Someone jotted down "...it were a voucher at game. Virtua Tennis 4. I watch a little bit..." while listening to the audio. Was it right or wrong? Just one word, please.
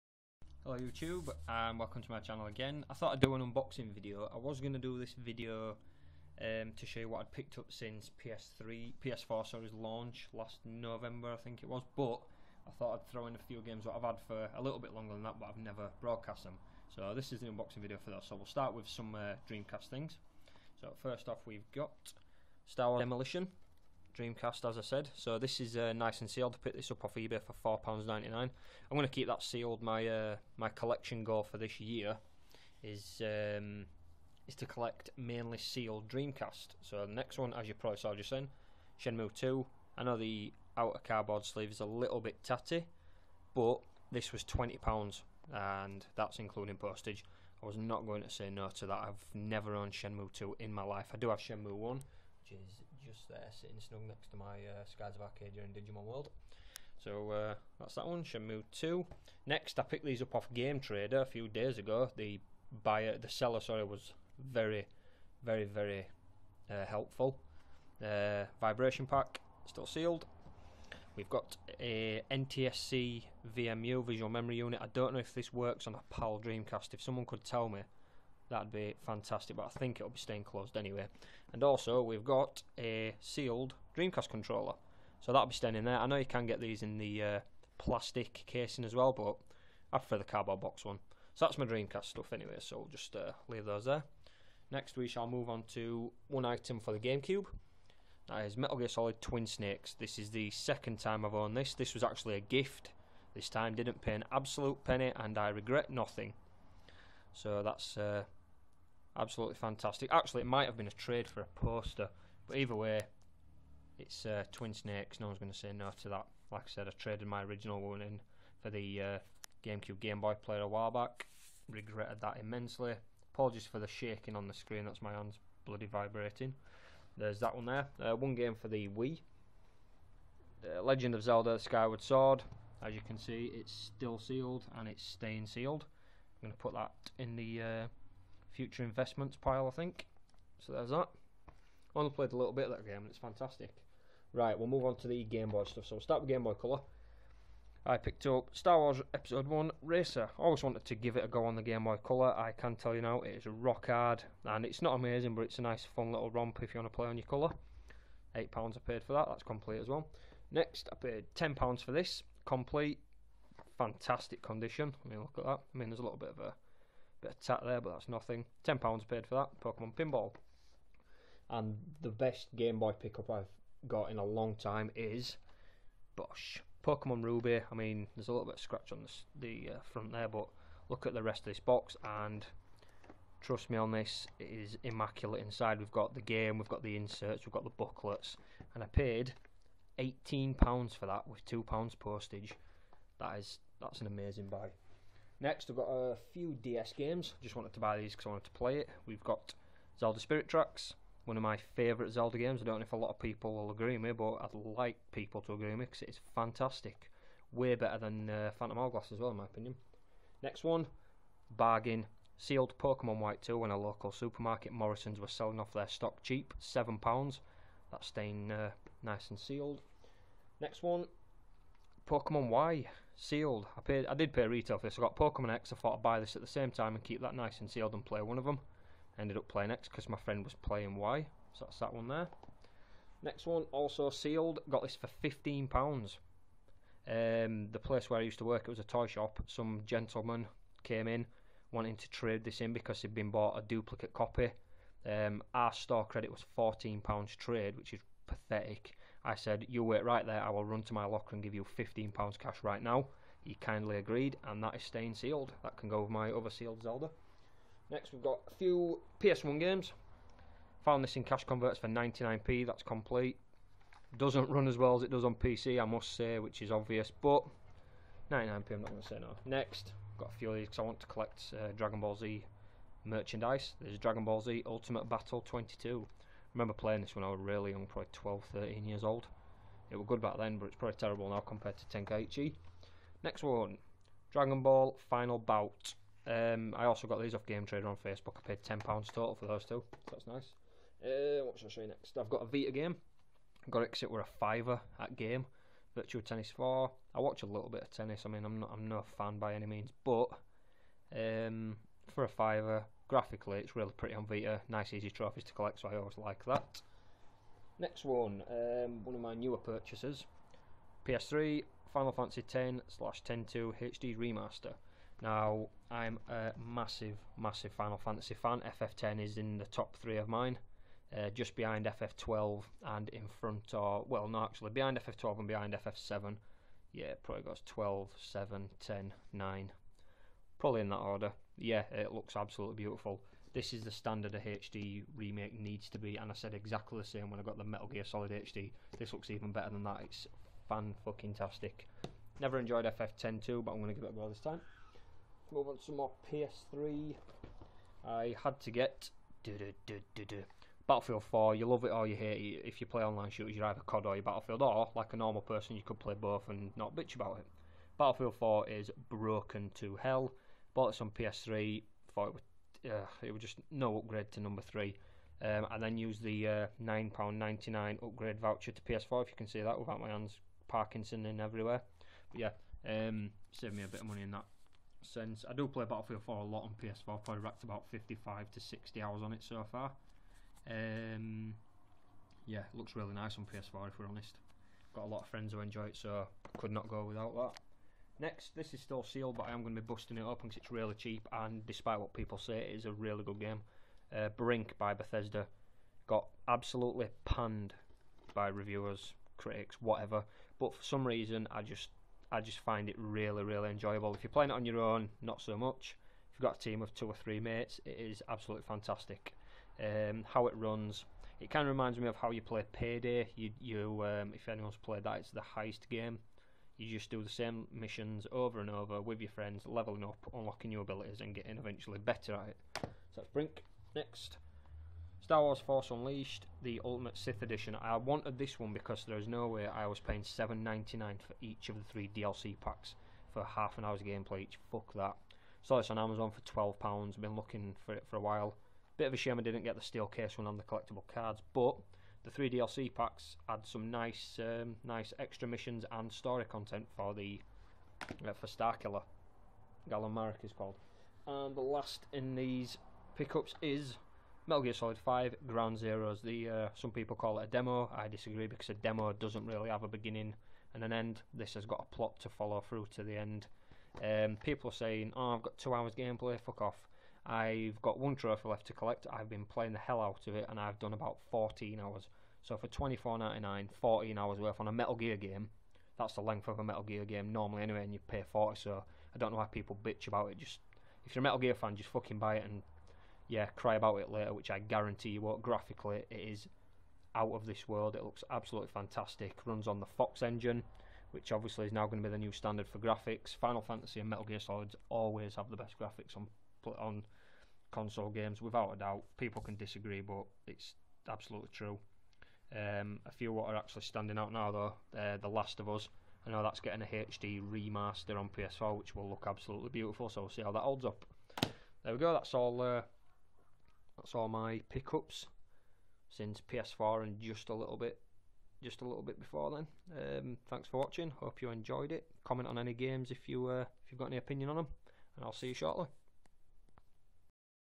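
wrong.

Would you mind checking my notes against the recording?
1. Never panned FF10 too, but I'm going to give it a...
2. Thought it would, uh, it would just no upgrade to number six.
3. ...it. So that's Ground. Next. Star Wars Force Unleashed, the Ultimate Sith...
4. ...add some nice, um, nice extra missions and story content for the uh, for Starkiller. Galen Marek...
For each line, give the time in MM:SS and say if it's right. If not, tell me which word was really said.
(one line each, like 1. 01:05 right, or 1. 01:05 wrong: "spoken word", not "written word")
1. 05:42 wrong: "enjoyed", not "panned"
2. 06:02 wrong: "three", not "six"
3. 07:02 wrong: "Brink", not "Ground"
4. 07:23 right.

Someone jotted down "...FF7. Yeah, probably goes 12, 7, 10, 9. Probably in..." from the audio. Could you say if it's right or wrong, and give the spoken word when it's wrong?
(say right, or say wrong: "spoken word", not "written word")
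right.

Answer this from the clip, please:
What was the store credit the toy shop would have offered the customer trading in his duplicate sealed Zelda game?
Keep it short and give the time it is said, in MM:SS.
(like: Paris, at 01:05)
£14, at 04:06.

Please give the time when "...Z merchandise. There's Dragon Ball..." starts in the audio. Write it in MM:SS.
04:32.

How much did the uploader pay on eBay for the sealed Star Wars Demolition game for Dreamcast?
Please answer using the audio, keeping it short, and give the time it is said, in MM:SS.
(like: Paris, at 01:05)
£4.99, at 00:27.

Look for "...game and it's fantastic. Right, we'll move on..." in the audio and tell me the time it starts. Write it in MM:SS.
02:22.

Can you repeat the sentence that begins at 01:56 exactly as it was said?
Like I said, I traded my original one in for the uh, GameCube Game Boy player a while back.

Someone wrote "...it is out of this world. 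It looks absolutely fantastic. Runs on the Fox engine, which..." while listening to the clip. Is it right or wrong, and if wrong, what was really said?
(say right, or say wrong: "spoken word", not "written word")
right.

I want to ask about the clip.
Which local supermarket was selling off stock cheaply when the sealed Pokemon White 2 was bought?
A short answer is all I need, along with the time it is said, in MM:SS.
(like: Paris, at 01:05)
Morrisons, at 03:34.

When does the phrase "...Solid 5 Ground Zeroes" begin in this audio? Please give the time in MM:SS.
07:34.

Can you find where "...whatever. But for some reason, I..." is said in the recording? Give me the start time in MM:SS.
06:39.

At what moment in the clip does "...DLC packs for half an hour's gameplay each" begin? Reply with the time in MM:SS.
07:12.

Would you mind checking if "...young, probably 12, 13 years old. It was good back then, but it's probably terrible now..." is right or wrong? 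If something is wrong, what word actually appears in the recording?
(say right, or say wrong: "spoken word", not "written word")
right.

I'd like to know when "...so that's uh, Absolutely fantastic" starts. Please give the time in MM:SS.
01:47.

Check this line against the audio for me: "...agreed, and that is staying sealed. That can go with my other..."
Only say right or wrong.
right.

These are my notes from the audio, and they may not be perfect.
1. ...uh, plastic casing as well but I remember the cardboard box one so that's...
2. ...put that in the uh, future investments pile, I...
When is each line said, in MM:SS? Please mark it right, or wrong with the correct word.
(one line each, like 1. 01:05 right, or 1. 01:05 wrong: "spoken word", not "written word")
1. 01:27 wrong: "prefer", not "remember"
2. 02:16 right.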